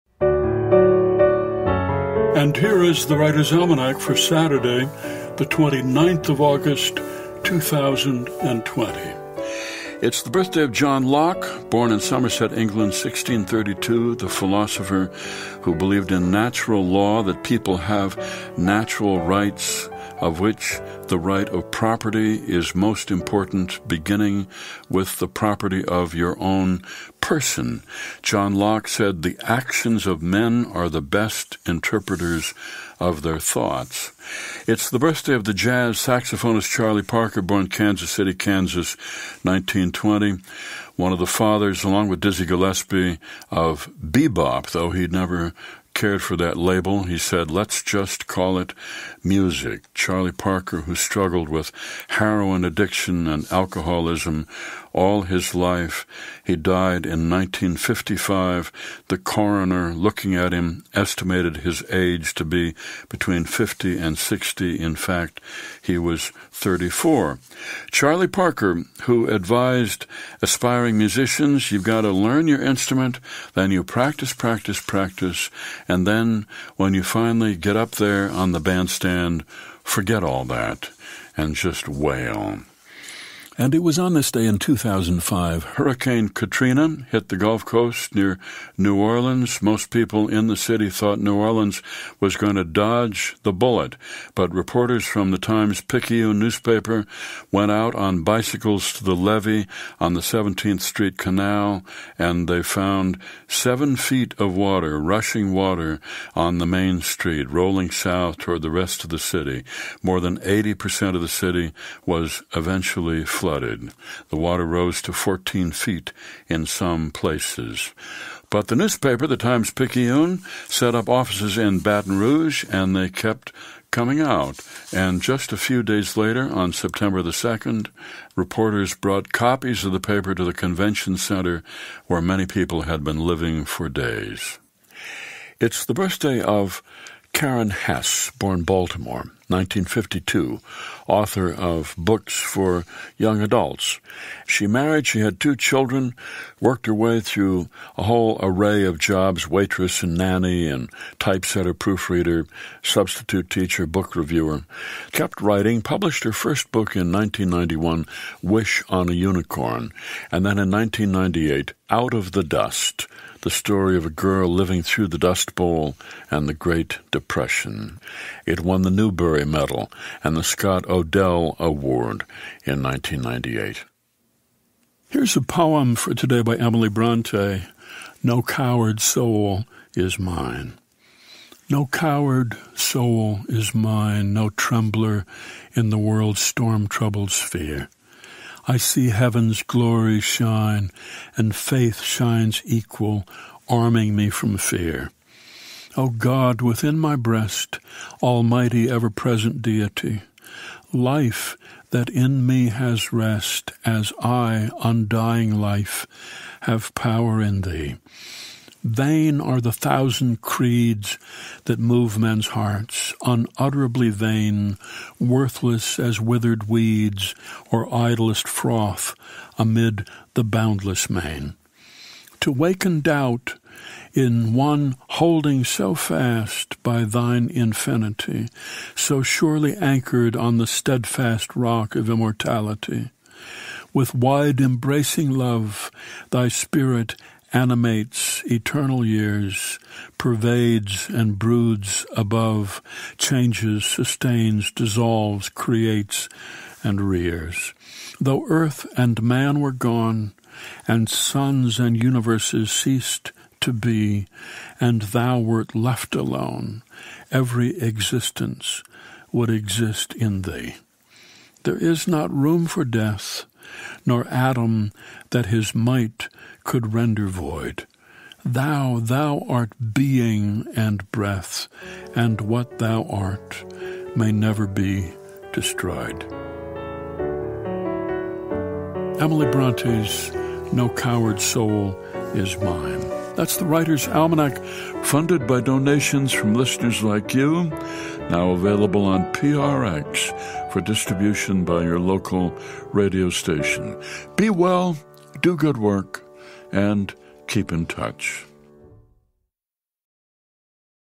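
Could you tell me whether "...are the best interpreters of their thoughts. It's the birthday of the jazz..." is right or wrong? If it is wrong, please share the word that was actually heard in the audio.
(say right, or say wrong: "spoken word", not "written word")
right.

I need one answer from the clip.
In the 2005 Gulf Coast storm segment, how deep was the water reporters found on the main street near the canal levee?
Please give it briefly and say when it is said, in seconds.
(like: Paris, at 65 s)
7 feet, at 103 s.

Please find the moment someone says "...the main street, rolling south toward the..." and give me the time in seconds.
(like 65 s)
106 s.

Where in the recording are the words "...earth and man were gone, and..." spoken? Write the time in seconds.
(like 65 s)
248 s.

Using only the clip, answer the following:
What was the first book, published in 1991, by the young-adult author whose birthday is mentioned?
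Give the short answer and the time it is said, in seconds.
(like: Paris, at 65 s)
Wish on a Unicorn, at 158 s.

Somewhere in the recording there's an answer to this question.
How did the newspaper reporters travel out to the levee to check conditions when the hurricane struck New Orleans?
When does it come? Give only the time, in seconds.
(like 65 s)
98 s.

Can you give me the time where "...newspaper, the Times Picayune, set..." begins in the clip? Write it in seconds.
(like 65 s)
118 s.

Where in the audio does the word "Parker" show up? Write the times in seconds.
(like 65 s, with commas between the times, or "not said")
37 s, 50 s, 68 s.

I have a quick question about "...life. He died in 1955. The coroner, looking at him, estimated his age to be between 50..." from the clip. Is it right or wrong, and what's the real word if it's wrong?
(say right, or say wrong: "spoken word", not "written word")
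right.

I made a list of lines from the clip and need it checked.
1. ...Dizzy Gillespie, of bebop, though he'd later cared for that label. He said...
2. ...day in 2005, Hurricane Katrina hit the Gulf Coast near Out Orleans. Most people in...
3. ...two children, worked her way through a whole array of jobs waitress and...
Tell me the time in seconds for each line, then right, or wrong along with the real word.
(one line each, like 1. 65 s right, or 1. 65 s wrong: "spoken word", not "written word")
1. 42 s wrong: "never", not "later"
2. 84 s wrong: "New", not "Out"
3. 145 s right.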